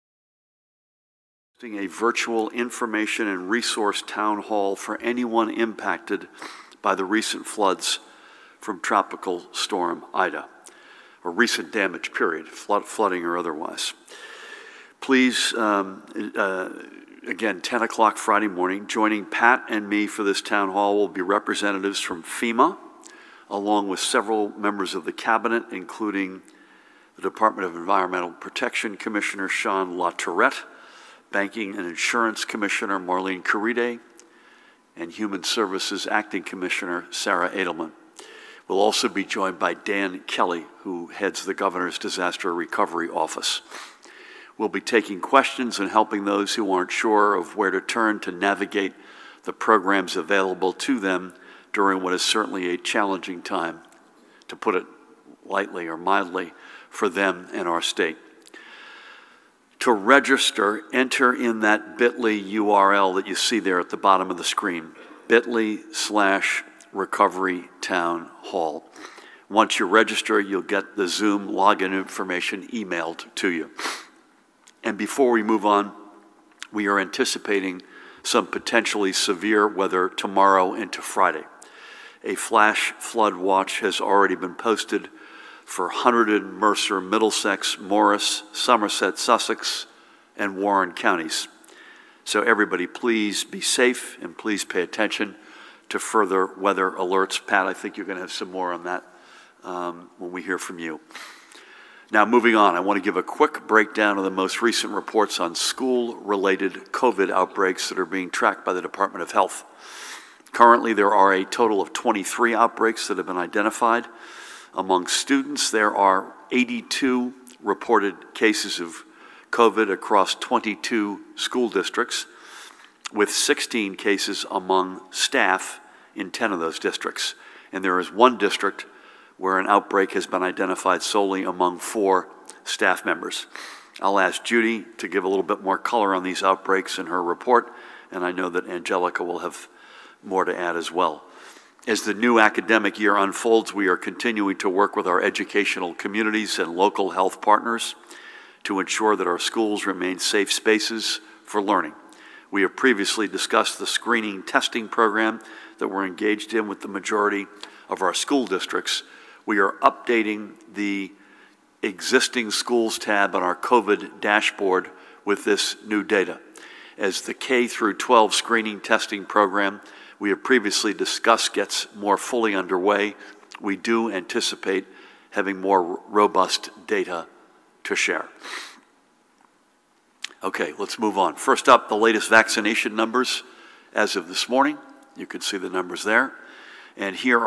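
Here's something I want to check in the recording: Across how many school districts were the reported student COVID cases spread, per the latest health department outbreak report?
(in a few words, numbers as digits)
22.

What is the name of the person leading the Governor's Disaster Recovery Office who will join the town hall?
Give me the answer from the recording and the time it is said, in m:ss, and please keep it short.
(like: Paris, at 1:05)
Dan Kelly, at 0:39.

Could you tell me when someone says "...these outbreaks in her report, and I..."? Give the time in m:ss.
2:16.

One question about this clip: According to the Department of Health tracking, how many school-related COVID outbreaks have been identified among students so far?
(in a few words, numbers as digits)
23.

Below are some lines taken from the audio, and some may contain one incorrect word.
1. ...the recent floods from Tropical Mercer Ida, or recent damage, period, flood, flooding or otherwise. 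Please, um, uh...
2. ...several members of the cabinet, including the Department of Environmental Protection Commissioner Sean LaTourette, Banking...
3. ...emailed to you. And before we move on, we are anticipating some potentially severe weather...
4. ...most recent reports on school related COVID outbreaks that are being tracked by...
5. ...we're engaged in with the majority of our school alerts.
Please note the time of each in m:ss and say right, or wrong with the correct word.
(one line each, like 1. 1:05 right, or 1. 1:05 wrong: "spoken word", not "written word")
1. 0:06 wrong: "Storm", not "Mercer"
2. 0:24 right
3. 1:12 right
4. 1:44 right
5. 2:35 wrong: "districts", not "alerts".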